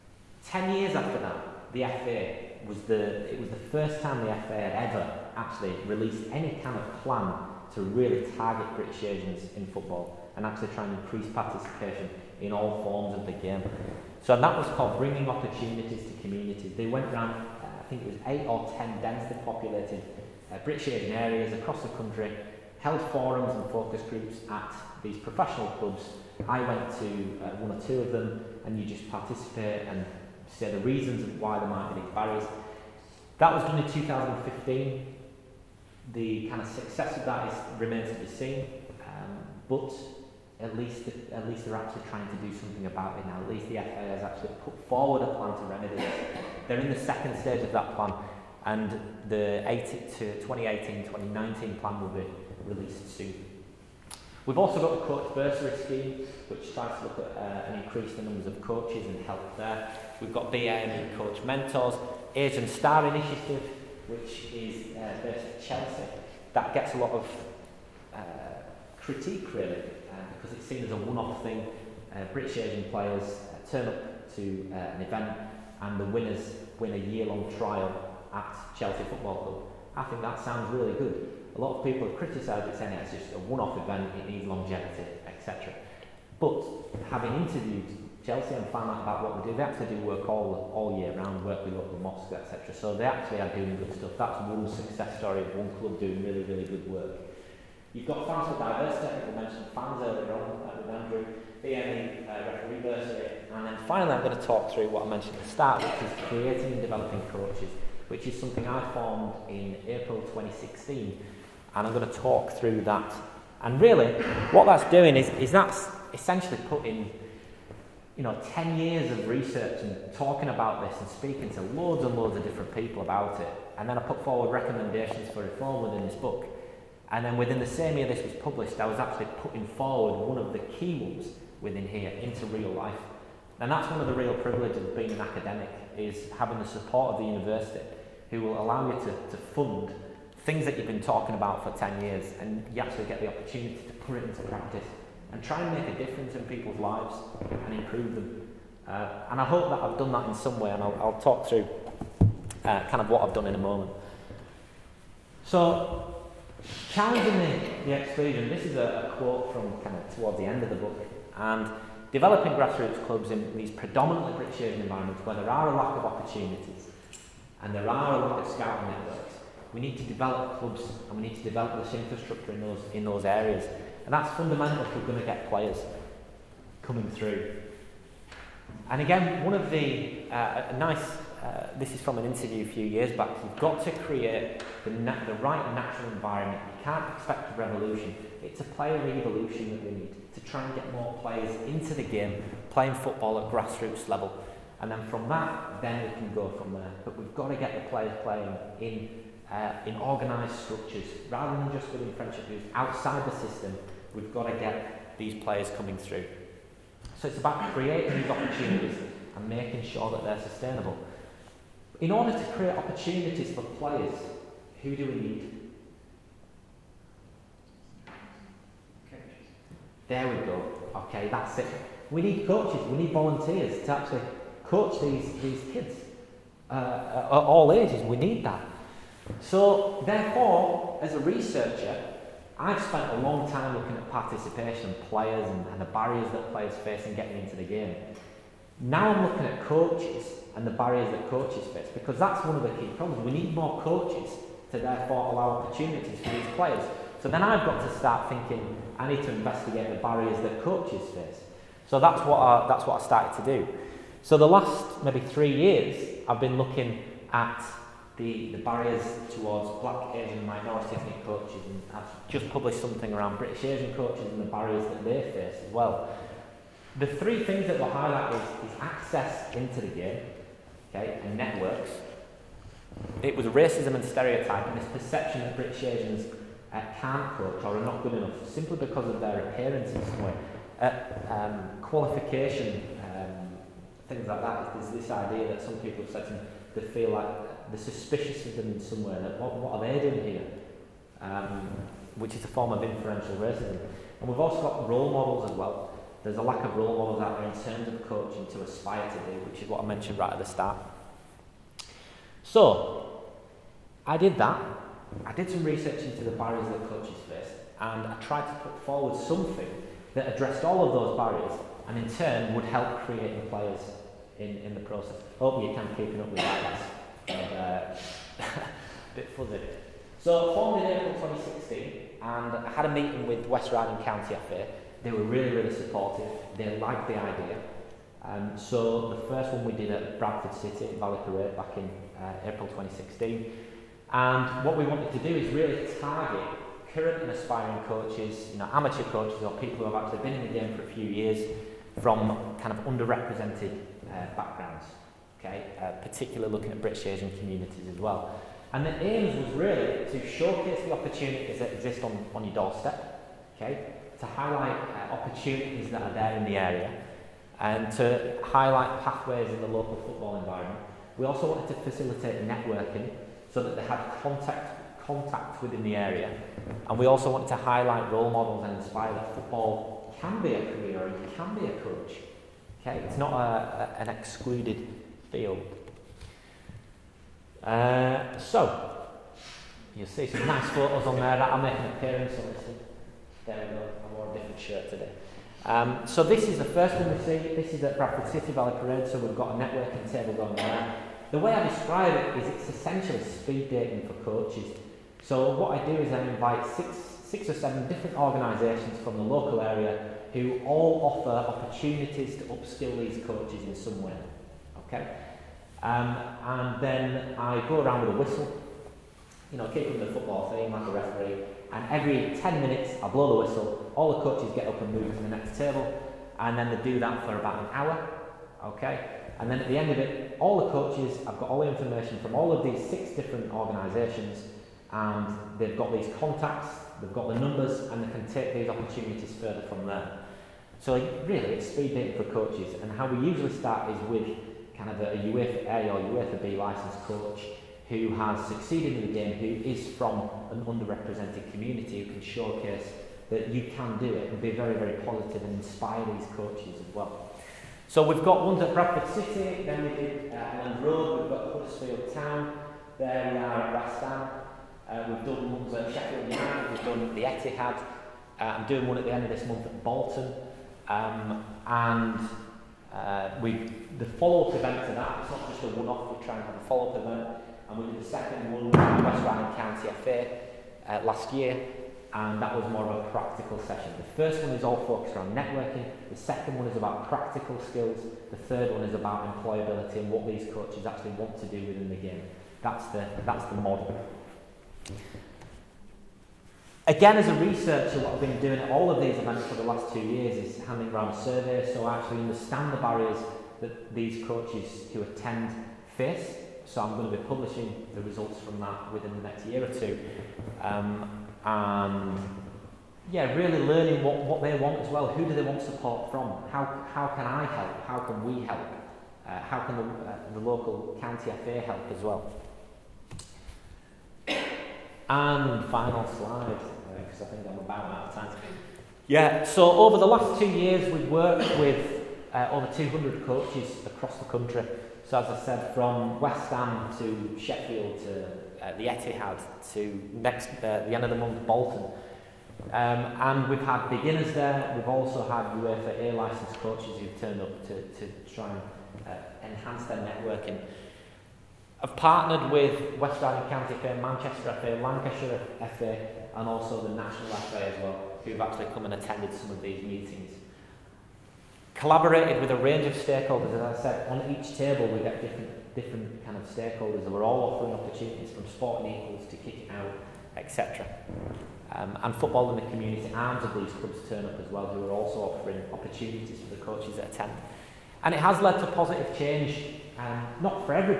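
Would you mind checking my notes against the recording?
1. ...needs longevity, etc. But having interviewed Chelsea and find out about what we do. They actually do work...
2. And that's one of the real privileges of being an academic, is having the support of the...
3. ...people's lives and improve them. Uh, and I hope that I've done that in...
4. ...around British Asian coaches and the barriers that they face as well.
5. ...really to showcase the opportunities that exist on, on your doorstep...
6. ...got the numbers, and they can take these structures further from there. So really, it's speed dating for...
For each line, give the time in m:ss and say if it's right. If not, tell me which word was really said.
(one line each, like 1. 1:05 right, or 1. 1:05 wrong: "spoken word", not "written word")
1. 1:24 right
2. 2:13 right
3. 2:26 right
4. 4:23 right
5. 5:49 right
6. 7:07 wrong: "opportunities", not "structures".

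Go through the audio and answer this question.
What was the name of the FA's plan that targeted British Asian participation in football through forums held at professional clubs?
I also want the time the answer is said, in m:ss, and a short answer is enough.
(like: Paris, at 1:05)
Bringing Opportunities to Communities, at 0:14.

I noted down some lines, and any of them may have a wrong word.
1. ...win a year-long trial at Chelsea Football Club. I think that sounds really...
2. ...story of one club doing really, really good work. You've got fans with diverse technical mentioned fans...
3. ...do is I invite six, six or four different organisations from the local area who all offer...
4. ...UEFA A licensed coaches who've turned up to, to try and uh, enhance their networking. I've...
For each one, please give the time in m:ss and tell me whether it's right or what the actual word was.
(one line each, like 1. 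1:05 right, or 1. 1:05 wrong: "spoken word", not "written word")
1. 1:16 right
2. 1:35 right
3. 6:35 wrong: "seven", not "four"
4. 8:55 right.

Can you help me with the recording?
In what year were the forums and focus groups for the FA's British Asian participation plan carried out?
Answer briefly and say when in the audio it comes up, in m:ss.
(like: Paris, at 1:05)
2015, at 0:33.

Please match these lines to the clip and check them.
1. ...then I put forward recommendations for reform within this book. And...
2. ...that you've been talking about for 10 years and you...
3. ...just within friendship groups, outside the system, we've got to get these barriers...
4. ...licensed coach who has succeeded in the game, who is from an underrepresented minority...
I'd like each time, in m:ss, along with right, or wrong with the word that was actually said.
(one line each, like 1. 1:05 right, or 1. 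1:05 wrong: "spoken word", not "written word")
1. 2:03 right
2. 2:20 right
3. 3:21 wrong: "players", not "barriers"
4. 7:16 wrong: "community", not "minority".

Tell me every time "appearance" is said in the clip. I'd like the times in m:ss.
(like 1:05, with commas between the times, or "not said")
4:39, 6:21.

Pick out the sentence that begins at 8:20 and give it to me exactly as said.
Um, and yeah, really learning what, what they want as well.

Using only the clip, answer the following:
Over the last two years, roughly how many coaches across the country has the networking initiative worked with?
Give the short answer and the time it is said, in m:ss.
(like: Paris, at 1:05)
Over 200, at 8:42.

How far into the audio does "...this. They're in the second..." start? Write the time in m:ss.
0:45.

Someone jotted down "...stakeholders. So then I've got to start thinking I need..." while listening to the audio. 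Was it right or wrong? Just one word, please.
wrong.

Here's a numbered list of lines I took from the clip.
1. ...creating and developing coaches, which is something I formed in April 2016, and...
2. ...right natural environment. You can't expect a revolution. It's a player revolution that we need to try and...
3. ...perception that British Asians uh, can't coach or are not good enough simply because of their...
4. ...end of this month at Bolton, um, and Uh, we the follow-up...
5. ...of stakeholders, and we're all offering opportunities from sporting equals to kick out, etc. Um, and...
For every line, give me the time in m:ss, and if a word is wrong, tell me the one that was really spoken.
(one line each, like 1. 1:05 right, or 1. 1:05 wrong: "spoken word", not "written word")
1. 1:46 right
2. 3:05 right
3. 4:34 right
4. 7:39 right
5. 9:16 right.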